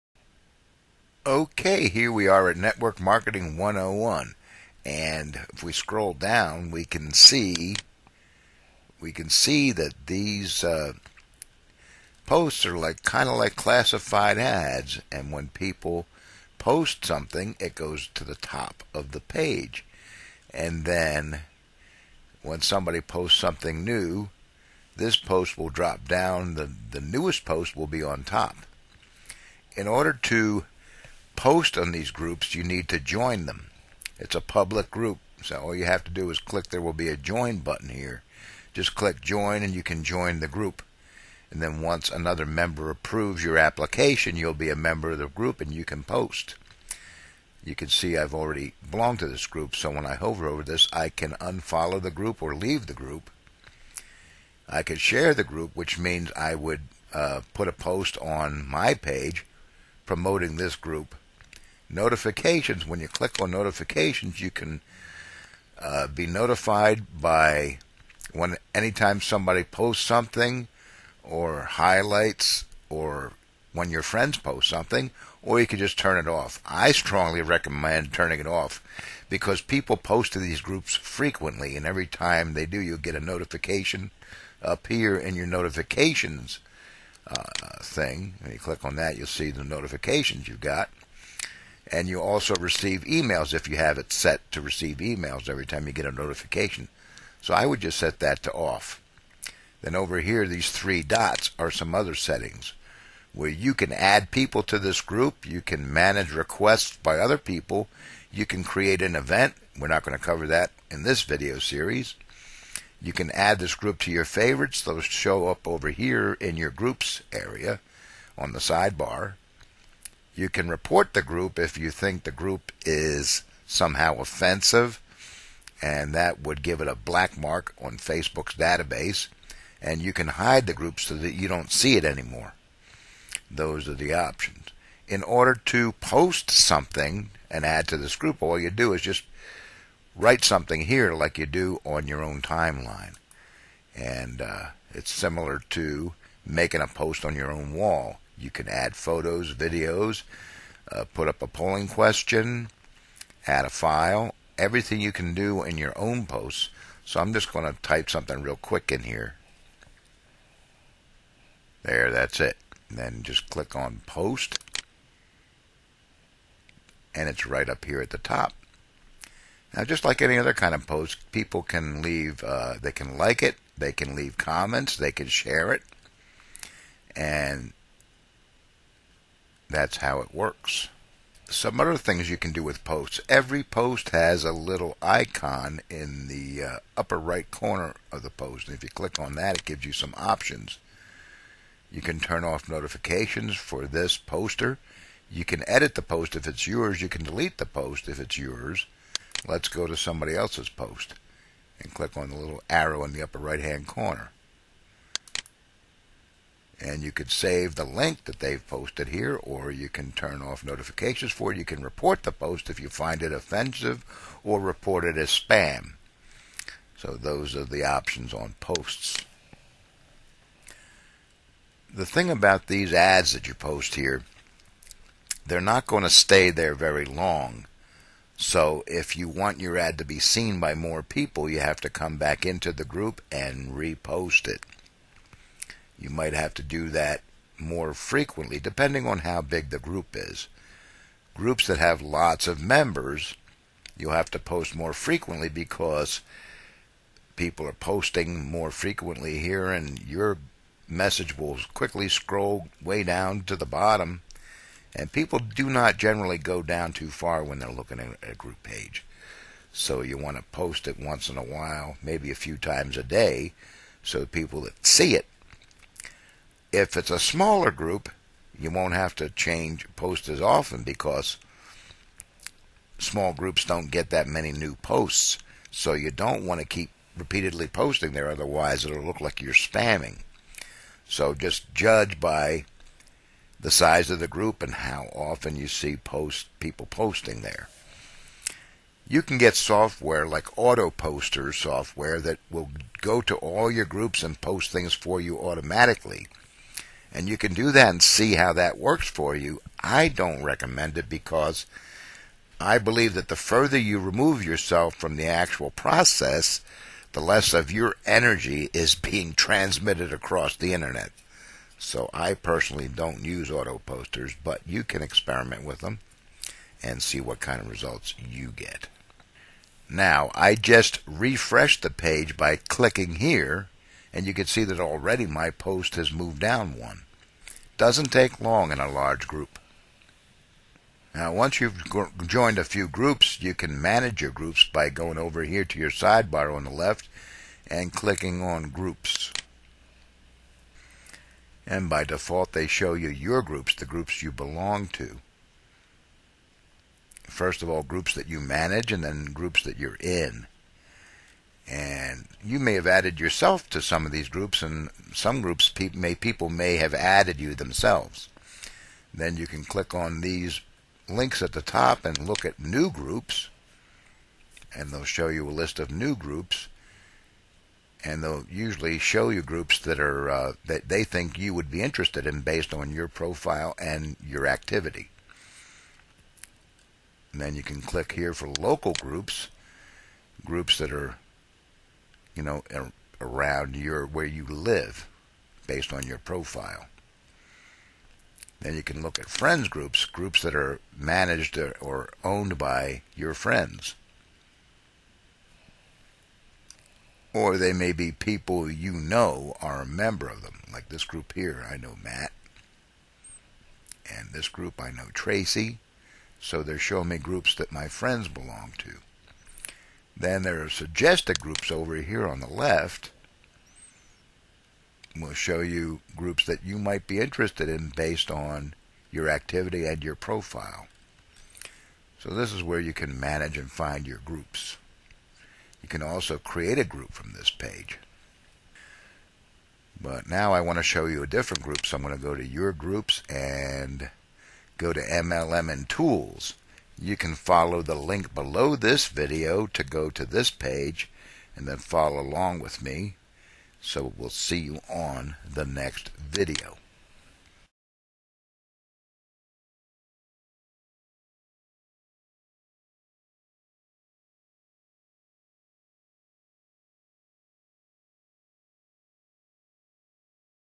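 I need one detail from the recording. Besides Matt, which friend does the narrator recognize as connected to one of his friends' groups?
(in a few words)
Tracy.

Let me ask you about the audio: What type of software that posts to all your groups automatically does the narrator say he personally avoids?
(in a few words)
auto poster software.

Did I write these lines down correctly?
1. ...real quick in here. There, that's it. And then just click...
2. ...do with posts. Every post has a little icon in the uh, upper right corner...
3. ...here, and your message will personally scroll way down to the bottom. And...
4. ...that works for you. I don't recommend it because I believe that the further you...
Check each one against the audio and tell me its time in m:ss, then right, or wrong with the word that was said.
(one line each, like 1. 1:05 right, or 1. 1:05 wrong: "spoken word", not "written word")
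1. 2:38 right
2. 3:02 right
3. 4:09 wrong: "quickly", not "personally"
4. 4:58 right.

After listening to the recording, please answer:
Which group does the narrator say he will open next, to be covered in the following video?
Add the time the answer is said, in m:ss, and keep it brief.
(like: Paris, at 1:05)
MLM and Tools, at 7:14.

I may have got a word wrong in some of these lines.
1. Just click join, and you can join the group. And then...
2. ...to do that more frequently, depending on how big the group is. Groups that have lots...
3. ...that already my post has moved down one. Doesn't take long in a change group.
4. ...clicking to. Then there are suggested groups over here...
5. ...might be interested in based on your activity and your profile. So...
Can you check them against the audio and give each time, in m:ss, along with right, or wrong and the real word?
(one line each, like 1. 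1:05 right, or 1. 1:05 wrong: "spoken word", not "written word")
1. 0:38 right
2. 3:56 right
3. 5:24 wrong: "large", not "change"
4. 6:48 wrong: "belong", not "clicking"
5. 6:56 right.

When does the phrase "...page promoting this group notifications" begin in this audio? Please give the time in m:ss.
0:58.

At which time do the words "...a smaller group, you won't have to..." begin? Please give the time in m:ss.
4:27.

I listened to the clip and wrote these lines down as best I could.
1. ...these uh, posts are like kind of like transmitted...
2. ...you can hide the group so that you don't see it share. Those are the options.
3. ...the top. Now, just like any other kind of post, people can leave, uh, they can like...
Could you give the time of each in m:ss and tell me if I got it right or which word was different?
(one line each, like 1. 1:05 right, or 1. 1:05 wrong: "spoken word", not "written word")
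1. 0:10 wrong: "classified", not "transmitted"
2. 2:10 wrong: "anymore", not "share"
3. 2:48 right.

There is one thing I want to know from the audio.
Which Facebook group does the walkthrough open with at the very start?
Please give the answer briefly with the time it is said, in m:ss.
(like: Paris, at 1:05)
Network Marketing 101, at 0:02.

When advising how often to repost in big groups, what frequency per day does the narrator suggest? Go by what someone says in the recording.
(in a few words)
a few times a day.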